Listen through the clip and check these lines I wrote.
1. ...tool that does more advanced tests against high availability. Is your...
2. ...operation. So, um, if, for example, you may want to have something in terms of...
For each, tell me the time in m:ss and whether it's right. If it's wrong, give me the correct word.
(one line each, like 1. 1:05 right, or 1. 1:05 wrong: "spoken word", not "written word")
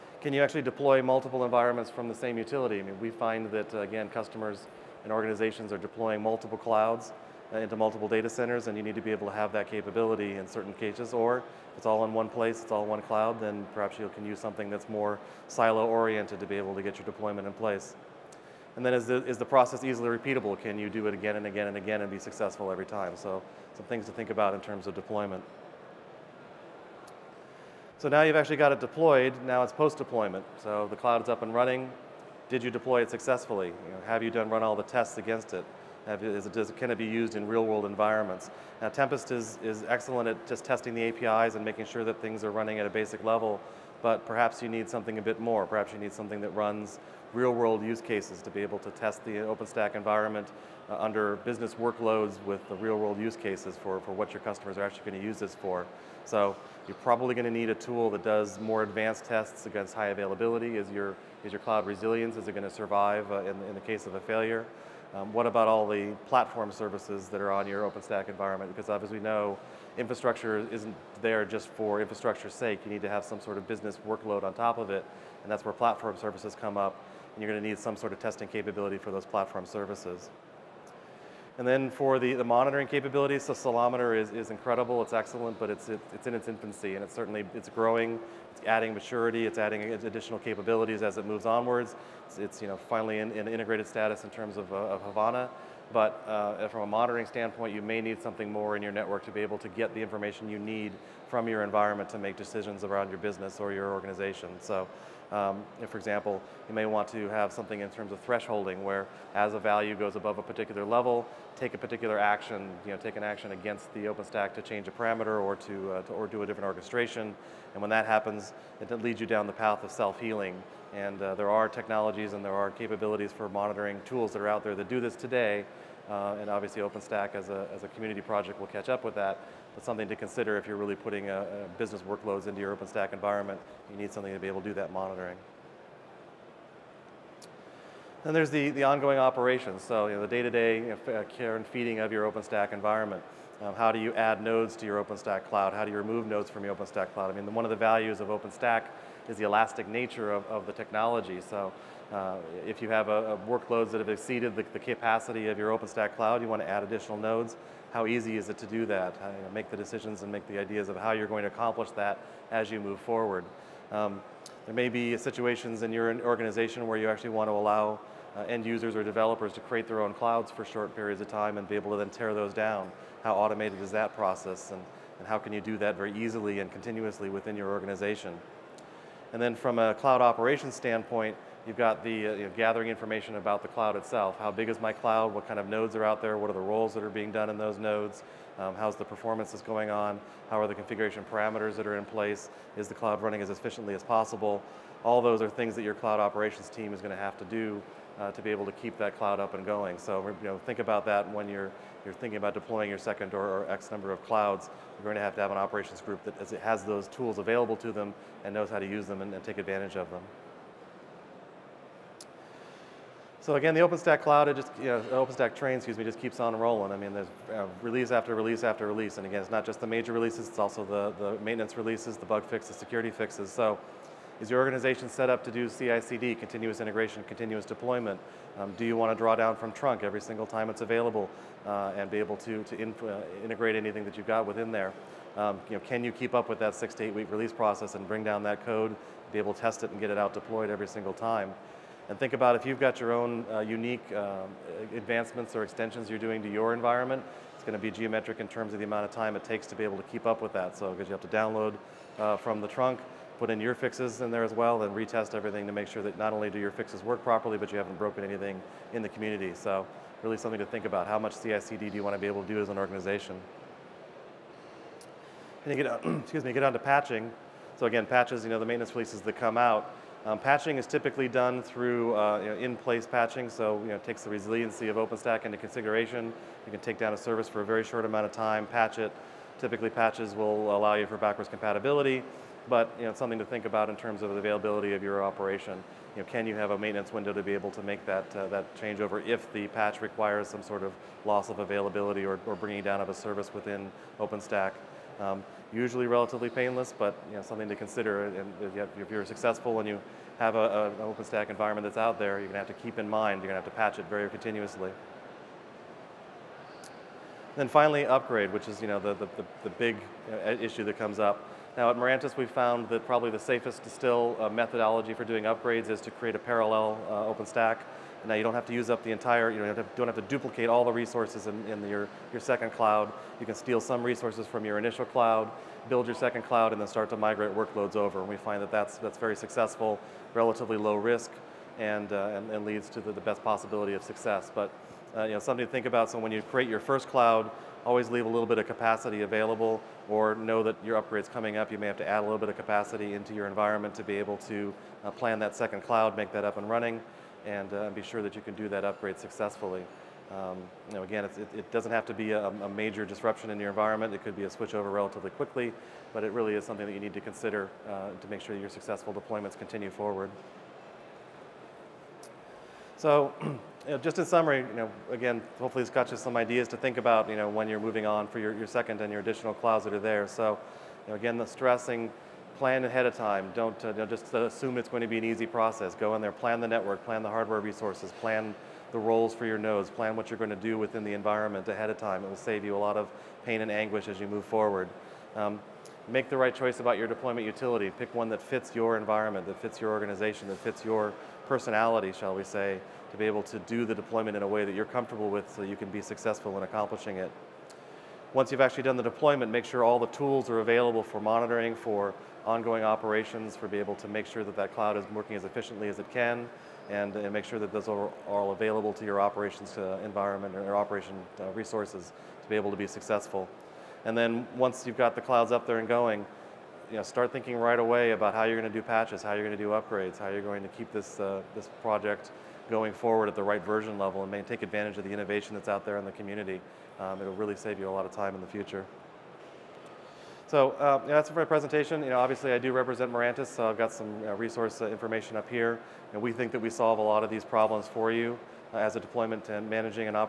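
1. 0:57 right
2. 1:43 wrong: "organization", not "operation".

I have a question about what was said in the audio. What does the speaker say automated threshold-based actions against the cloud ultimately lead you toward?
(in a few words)
self-healing.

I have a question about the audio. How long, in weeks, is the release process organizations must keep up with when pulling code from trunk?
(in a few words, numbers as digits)
6 to 8 weeks.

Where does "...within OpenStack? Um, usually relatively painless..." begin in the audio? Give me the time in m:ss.
4:53.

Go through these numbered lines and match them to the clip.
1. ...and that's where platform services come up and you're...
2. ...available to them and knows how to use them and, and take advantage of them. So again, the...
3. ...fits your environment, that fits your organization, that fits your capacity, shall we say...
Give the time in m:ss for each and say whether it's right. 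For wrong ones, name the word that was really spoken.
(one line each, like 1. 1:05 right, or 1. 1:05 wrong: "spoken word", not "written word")
1. 1:15 right
2. 3:27 right
3. 6:28 wrong: "personality", not "capacity".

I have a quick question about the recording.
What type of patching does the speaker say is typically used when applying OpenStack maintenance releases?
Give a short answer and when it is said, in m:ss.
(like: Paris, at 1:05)
in-place patching, at 4:32.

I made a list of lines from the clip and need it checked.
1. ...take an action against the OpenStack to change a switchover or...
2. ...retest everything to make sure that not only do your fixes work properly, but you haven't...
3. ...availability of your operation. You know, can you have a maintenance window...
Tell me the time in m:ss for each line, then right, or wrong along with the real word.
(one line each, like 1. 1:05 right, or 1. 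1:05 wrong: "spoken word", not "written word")
1. 1:52 wrong: "parameter", not "switchover"
2. 4:14 right
3. 4:44 right.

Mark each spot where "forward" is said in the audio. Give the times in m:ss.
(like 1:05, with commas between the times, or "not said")
2:42, 5:59, 6:24, 7:02.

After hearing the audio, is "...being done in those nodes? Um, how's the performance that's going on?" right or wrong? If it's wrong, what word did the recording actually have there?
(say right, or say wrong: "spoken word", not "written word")
right.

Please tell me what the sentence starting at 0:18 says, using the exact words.
And then is the, is the process easily repeatable?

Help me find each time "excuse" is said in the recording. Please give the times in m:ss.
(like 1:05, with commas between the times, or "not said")
3:35, 4:26.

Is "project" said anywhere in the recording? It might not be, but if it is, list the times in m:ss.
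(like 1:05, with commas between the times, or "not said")
2:08, 7:01.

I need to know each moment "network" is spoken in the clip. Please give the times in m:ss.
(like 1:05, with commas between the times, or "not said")
1:38, 6:16.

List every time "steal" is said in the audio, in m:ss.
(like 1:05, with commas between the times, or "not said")
5:23.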